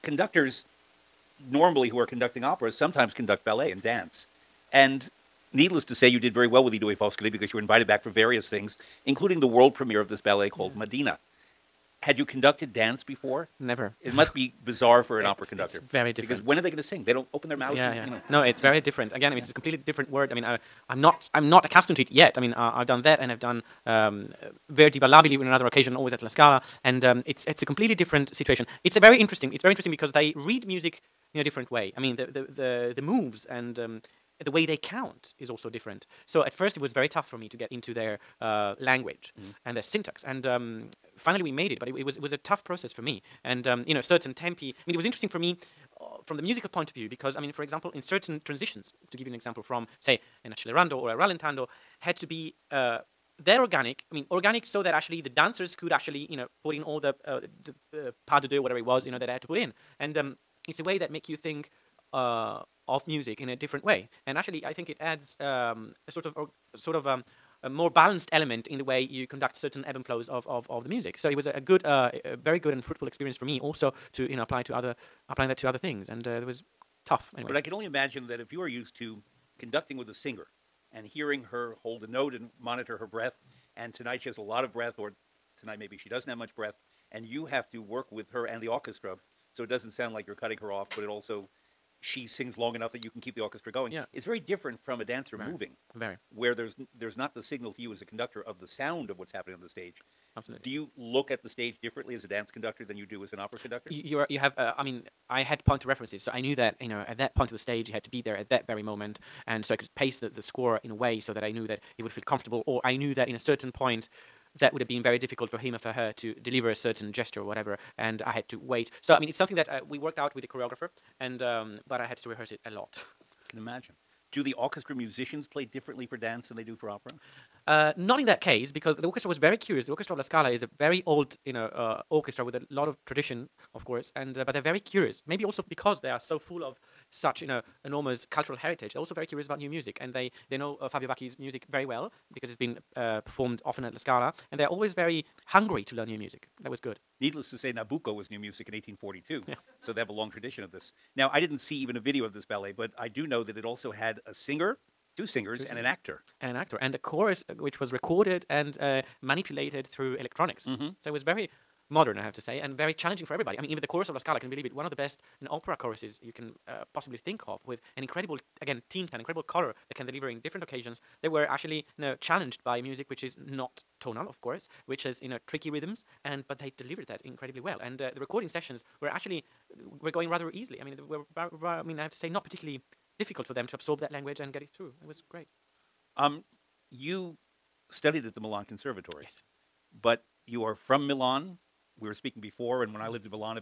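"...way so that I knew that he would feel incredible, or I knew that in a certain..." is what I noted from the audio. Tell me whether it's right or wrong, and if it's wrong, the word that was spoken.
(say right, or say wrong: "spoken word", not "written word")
wrong: "comfortable", not "incredible".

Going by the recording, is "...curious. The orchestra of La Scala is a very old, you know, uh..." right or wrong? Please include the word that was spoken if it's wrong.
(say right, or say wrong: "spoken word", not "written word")
right.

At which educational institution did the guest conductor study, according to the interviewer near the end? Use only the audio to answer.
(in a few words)
Milan Conservatory.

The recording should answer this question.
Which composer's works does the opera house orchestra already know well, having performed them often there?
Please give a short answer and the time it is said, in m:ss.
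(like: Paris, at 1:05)
Fabio Vacchi, at 2:20.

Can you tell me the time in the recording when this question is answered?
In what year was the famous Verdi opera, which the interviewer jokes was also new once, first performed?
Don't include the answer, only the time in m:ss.
2:28.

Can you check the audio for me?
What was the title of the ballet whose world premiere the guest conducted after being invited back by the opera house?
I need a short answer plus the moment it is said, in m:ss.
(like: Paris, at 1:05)
Madina, at 0:10.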